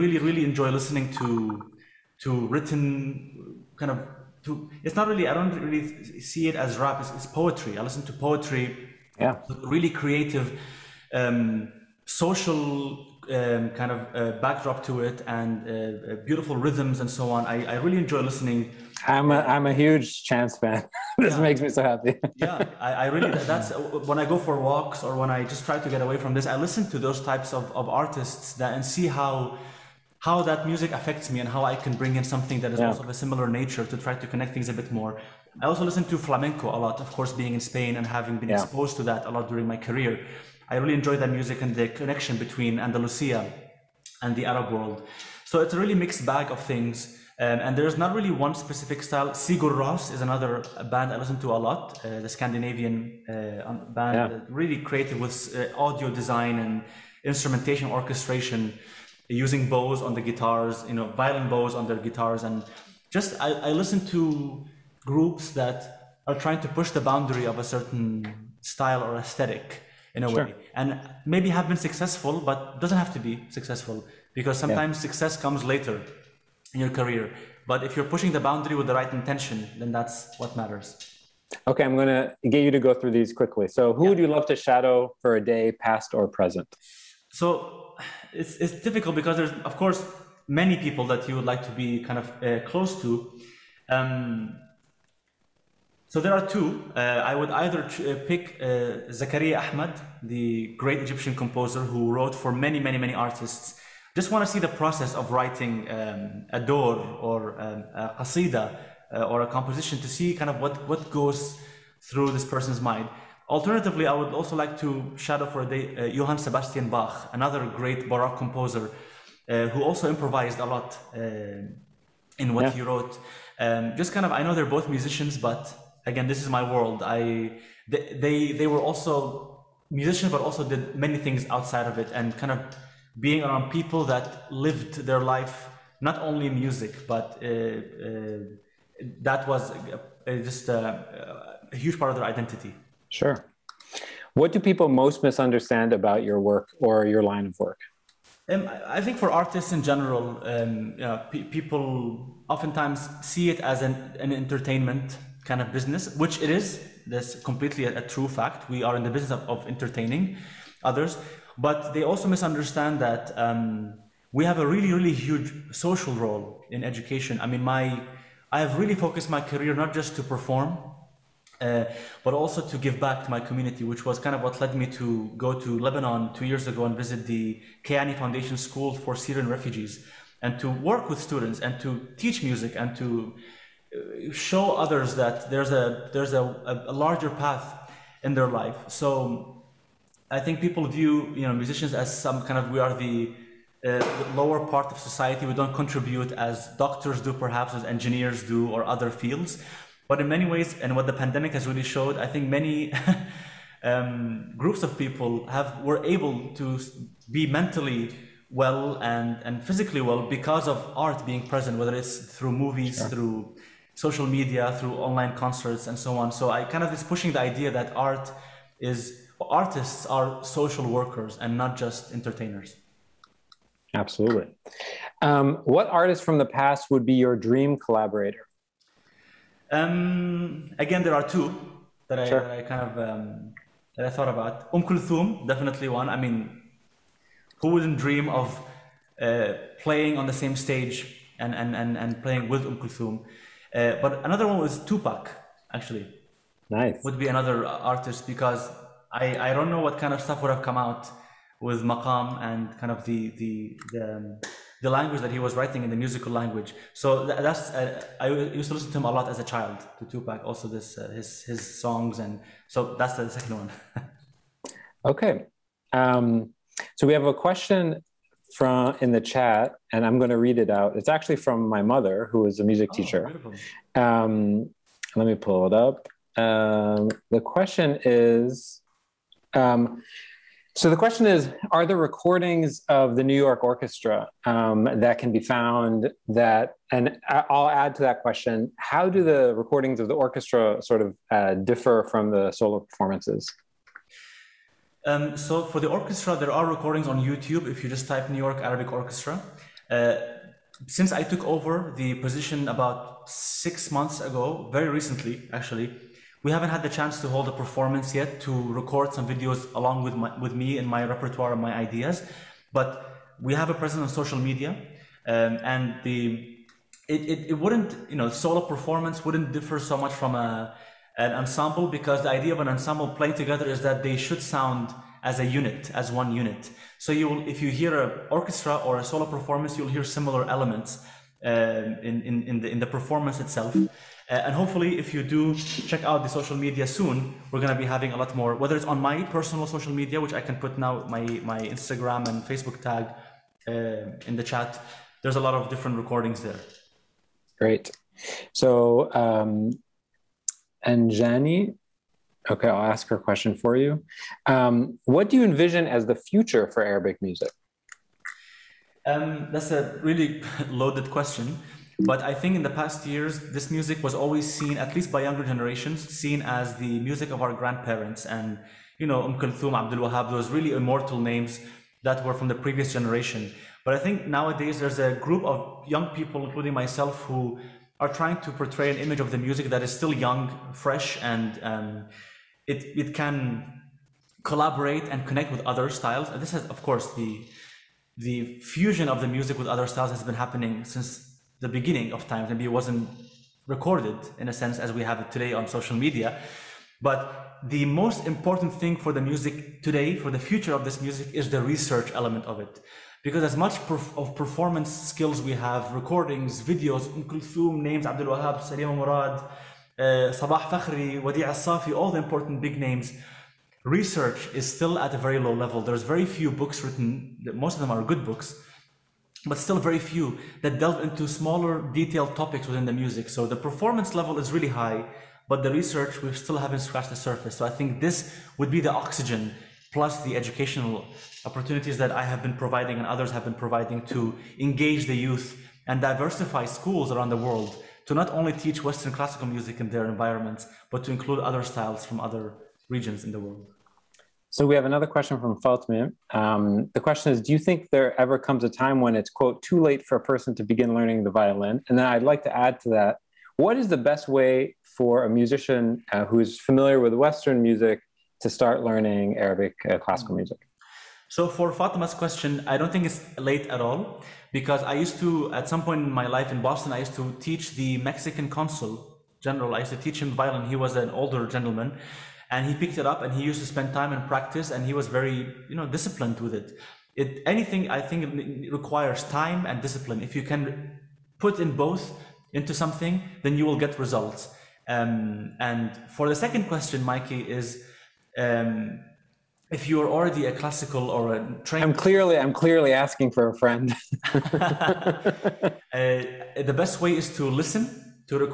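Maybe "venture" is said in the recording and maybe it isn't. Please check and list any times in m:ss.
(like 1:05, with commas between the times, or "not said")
not said.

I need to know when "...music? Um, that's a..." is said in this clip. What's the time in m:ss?
5:57.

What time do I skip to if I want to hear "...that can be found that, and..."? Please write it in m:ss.
4:45.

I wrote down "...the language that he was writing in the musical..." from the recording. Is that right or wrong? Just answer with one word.
right.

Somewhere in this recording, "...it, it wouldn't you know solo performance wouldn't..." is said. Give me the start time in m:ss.
5:17.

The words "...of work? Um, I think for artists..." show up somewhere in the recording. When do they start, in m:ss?
2:27.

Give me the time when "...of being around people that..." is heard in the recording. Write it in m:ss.
2:12.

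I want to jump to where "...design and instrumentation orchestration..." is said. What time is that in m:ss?
0:56.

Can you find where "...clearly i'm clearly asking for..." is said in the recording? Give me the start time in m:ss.
8:11.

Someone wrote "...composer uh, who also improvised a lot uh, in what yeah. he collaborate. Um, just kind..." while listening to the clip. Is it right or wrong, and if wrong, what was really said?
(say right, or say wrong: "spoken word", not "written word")
wrong: "wrote", not "collaborate".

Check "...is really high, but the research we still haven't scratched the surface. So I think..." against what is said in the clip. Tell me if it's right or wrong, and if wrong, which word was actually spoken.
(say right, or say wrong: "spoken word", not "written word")
right.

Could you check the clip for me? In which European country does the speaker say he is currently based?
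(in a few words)
Spain.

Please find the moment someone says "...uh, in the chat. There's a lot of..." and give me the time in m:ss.
5:43.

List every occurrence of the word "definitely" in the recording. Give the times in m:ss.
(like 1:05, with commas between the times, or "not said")
3:55.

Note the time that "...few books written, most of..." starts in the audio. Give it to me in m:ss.
6:56.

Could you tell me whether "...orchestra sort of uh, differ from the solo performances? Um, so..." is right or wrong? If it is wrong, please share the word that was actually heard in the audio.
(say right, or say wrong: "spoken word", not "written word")
right.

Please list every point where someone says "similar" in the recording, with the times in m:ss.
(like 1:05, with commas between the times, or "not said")
0:33, 5:30.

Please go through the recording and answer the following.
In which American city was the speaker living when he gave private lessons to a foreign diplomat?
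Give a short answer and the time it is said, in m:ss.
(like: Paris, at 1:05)
Boston, at 7:46.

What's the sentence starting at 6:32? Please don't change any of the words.
Maybe it wasn't recorded in a sense as we have it today on social media.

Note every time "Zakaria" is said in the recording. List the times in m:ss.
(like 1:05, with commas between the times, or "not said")
1:39.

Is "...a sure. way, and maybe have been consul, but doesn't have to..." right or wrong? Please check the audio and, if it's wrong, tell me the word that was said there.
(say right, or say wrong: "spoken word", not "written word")
wrong: "successful", not "consul".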